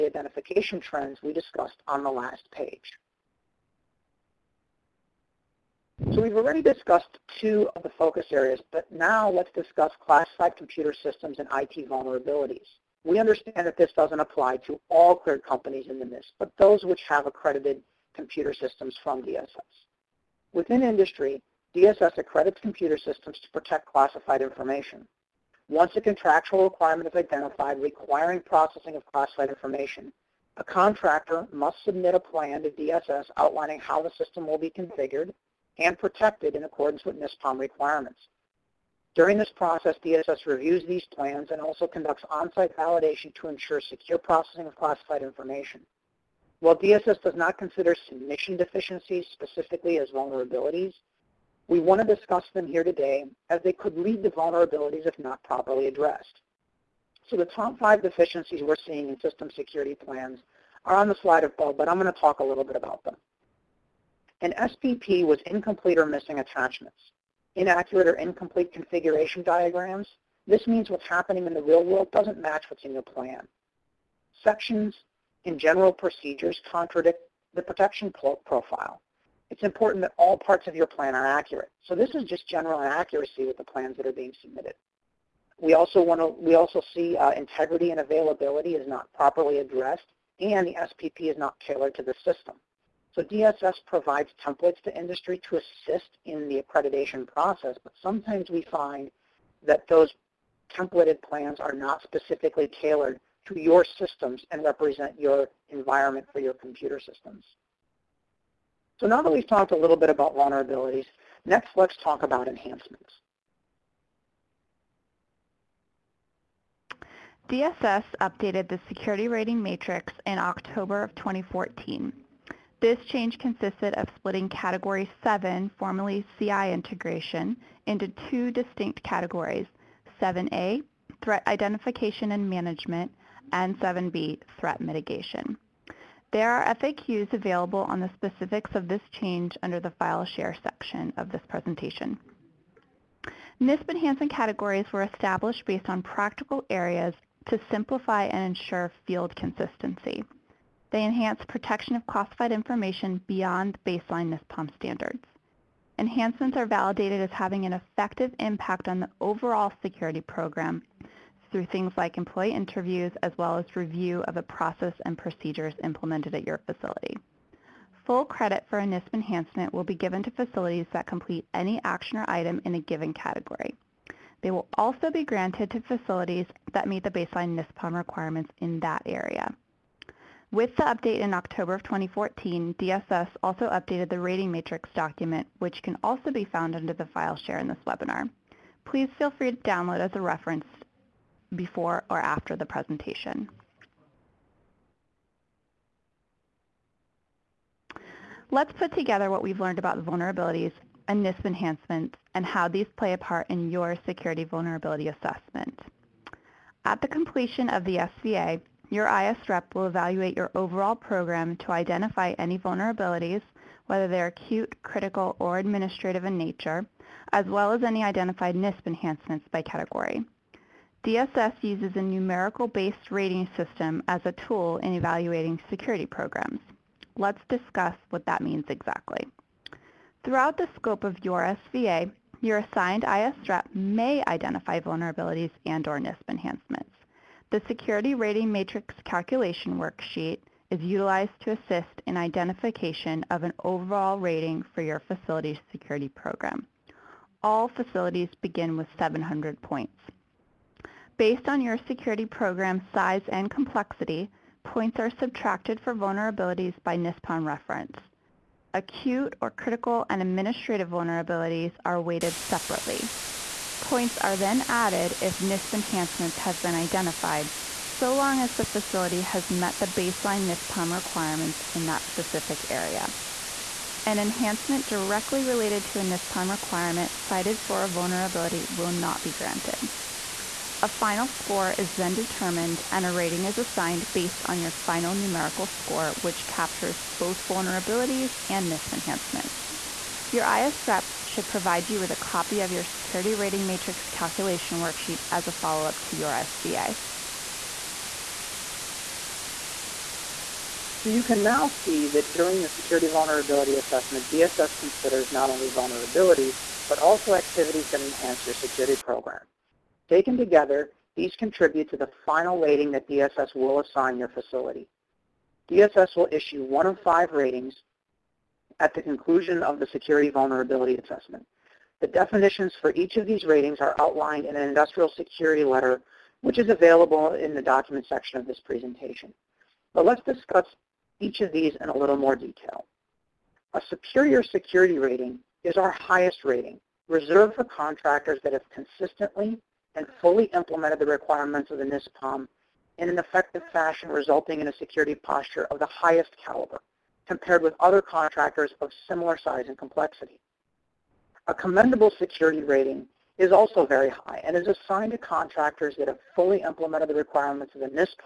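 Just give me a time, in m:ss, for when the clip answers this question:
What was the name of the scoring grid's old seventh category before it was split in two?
2:06.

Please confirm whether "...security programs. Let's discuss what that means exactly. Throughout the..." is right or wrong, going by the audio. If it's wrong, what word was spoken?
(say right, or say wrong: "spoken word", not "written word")
right.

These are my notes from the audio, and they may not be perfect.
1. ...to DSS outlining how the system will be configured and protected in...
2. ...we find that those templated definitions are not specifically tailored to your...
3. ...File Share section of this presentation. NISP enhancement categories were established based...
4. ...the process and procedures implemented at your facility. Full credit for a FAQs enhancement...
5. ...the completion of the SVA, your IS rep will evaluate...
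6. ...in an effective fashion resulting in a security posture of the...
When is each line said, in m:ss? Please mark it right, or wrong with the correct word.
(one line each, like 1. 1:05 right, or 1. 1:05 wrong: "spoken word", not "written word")
1. 0:32 right
2. 1:38 wrong: "plans", not "definitions"
3. 2:19 right
4. 2:44 wrong: "NISP", not "FAQs"
5. 3:27 right
6. 5:42 right.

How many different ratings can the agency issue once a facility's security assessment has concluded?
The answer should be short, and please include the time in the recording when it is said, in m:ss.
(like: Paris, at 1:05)
5, at 5:17.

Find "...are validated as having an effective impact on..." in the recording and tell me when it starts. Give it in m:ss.
2:36.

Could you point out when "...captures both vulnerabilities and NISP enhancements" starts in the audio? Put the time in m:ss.
4:46.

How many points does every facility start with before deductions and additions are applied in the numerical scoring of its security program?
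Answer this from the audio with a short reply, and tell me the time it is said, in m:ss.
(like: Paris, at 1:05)
700, at 4:08.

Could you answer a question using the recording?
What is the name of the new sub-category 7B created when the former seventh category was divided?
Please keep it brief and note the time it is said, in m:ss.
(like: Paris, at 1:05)
threat mitigation, at 2:14.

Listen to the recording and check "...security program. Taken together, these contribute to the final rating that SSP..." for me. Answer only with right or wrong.
wrong.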